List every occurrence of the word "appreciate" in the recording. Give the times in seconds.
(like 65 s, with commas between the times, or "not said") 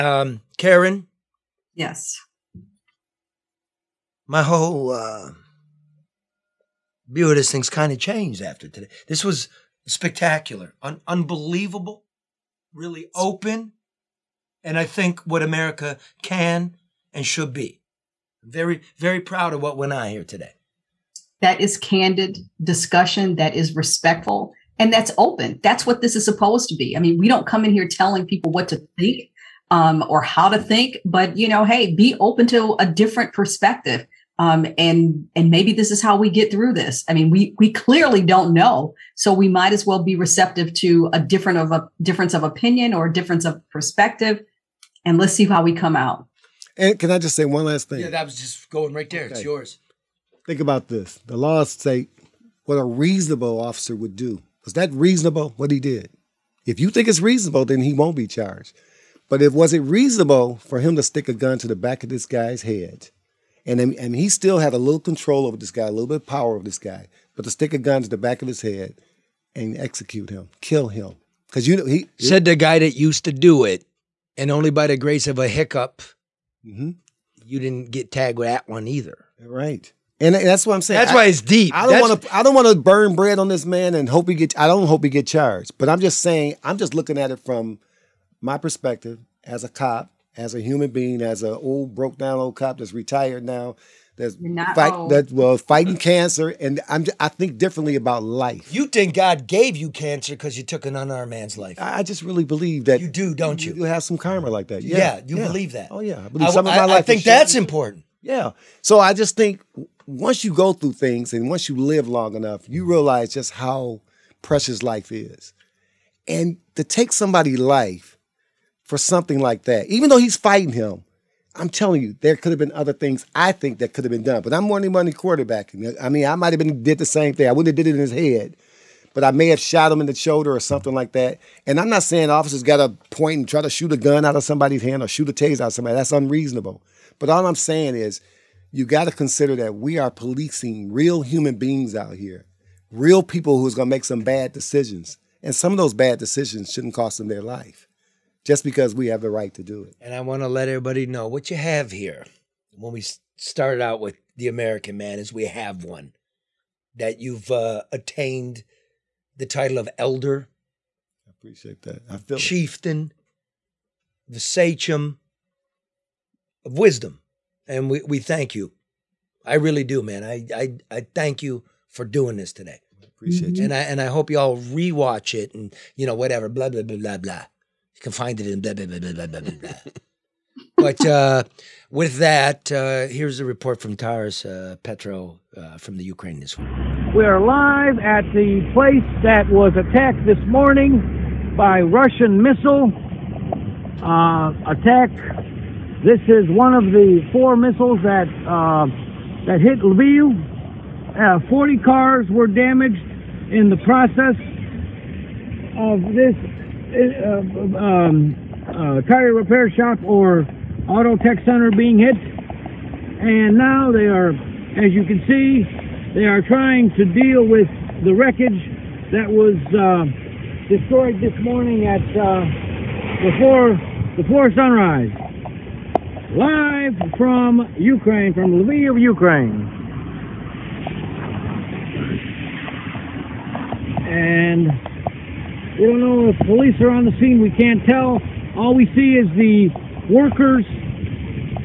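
161 s, 173 s.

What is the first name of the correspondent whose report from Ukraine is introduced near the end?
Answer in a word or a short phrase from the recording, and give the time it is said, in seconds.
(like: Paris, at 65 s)
Taras, at 183 s.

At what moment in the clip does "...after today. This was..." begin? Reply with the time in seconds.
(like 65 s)
8 s.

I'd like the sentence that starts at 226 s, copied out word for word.
Live from Ukraine, from Lviv, Ukraine.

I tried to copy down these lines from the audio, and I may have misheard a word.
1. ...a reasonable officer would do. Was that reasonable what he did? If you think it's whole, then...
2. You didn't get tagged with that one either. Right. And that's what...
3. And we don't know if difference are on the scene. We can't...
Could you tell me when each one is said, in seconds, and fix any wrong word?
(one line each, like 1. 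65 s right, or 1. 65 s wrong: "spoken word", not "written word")
1. 52 s wrong: "reasonable", not "whole"
2. 77 s right
3. 234 s wrong: "police", not "difference".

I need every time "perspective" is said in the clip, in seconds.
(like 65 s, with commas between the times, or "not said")
33 s, 43 s, 88 s.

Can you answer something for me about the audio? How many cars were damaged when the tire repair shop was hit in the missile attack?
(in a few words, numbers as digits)
40.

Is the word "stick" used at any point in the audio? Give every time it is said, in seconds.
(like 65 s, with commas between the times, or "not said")
61 s, 67 s.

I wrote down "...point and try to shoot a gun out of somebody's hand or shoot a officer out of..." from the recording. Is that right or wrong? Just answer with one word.
wrong.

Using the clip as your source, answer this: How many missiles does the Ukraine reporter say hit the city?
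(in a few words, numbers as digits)
4.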